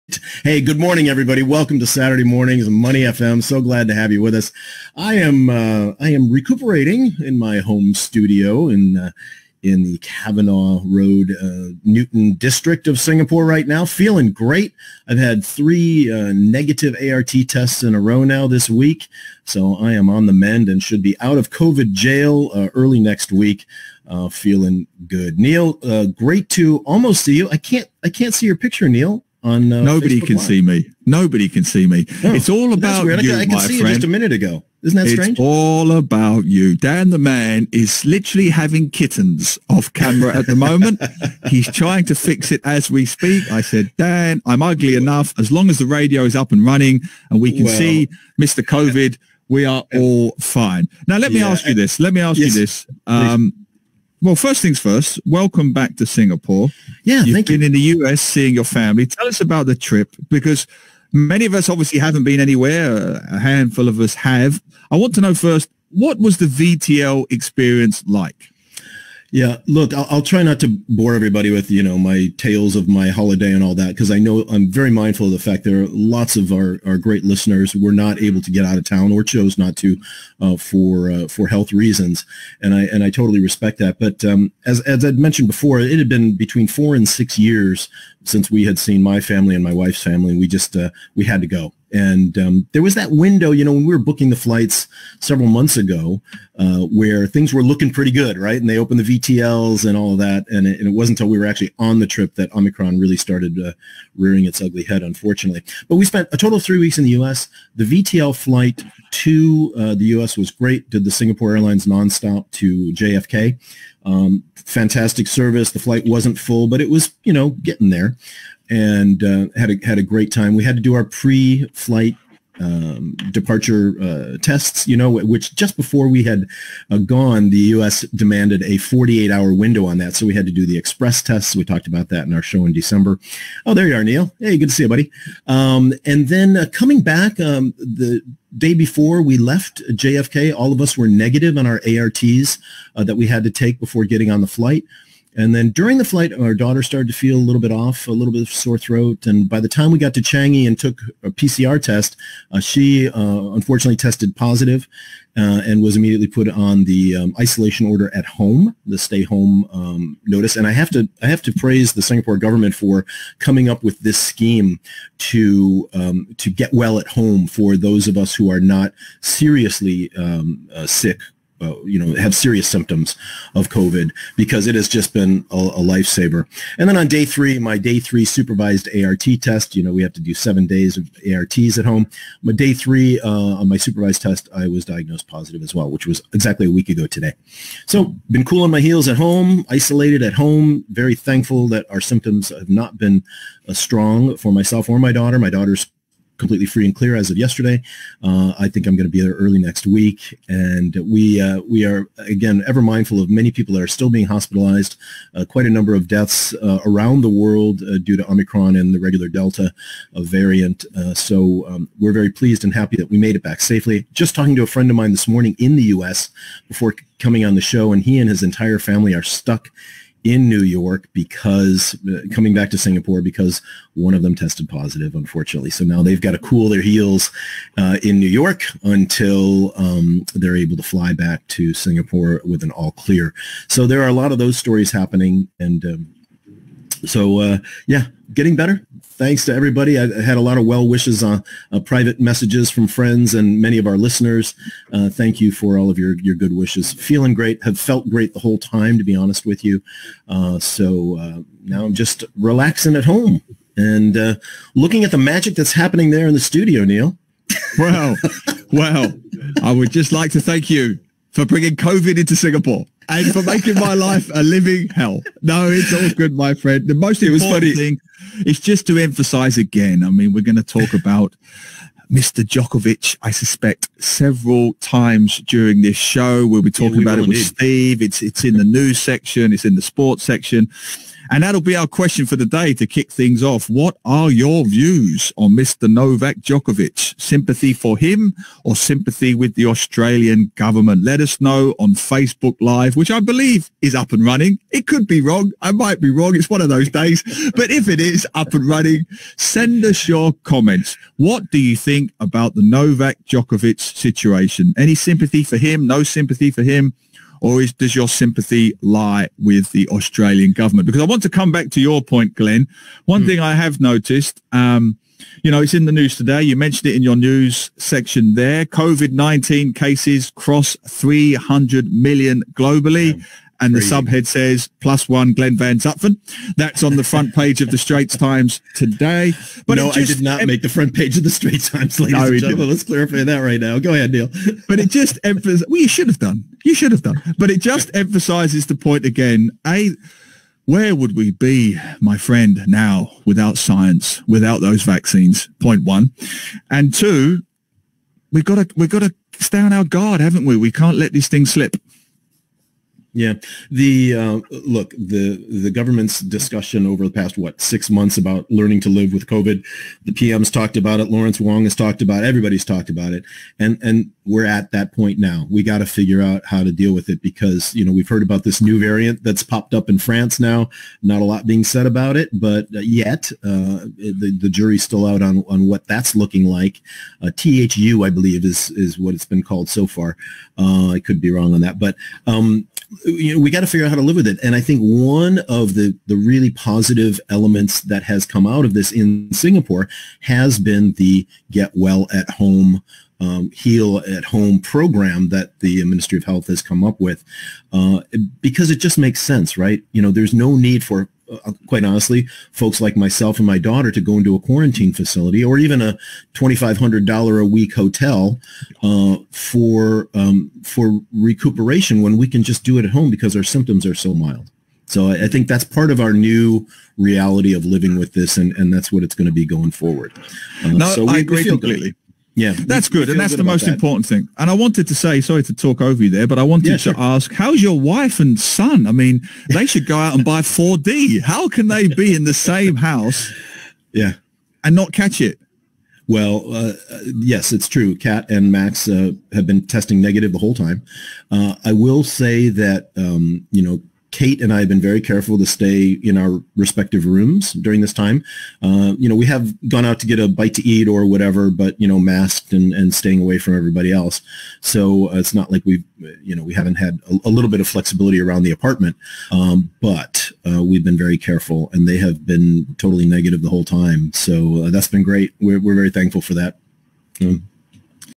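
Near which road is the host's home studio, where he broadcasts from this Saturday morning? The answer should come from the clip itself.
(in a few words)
Cavenagh Road.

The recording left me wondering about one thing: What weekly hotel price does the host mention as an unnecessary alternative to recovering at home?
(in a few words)
$2,500.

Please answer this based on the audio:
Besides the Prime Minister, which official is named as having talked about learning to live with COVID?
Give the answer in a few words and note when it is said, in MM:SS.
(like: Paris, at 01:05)
Lawrence Wong, at 06:01.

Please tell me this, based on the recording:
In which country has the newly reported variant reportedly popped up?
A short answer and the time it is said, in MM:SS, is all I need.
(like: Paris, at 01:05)
France, at 06:09.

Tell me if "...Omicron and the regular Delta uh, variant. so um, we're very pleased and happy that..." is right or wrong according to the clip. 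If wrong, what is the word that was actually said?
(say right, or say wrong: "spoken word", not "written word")
right.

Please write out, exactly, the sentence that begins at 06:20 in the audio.
Uh, I could be wrong on that, but um, you know, we got to figure out how to live with it.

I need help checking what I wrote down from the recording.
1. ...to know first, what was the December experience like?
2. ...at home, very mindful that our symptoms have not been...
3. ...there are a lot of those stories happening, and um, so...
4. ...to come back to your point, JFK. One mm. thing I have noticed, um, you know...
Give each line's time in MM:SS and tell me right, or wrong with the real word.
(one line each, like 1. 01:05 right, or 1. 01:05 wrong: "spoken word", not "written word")
1. 01:05 wrong: "VTL", not "December"
2. 03:10 wrong: "thankful", not "mindful"
3. 03:53 right
4. 05:11 wrong: "Glenn", not "JFK".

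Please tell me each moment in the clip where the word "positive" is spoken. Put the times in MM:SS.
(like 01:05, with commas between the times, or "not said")
02:34, 03:05, 03:44, 06:26.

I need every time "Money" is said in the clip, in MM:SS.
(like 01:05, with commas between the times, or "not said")
00:02.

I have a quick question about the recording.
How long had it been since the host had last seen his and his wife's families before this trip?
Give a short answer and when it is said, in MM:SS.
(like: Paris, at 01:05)
4 to 6 years, at 01:26.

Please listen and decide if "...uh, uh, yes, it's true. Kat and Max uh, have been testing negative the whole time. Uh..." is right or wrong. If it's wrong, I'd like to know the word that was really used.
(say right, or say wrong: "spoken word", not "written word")
right.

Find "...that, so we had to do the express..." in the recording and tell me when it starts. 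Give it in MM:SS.
02:09.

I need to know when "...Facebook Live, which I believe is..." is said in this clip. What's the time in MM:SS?
04:51.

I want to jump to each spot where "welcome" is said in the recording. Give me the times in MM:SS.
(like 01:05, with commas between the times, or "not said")
00:01, 00:55.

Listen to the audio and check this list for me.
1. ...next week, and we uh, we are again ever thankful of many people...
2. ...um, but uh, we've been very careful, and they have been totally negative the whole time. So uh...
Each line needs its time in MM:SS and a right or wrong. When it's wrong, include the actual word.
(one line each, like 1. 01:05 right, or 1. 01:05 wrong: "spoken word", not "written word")
1. 03:19 wrong: "mindful", not "thankful"
2. 07:39 right.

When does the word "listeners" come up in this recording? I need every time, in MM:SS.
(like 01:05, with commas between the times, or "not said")
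01:17, 04:03.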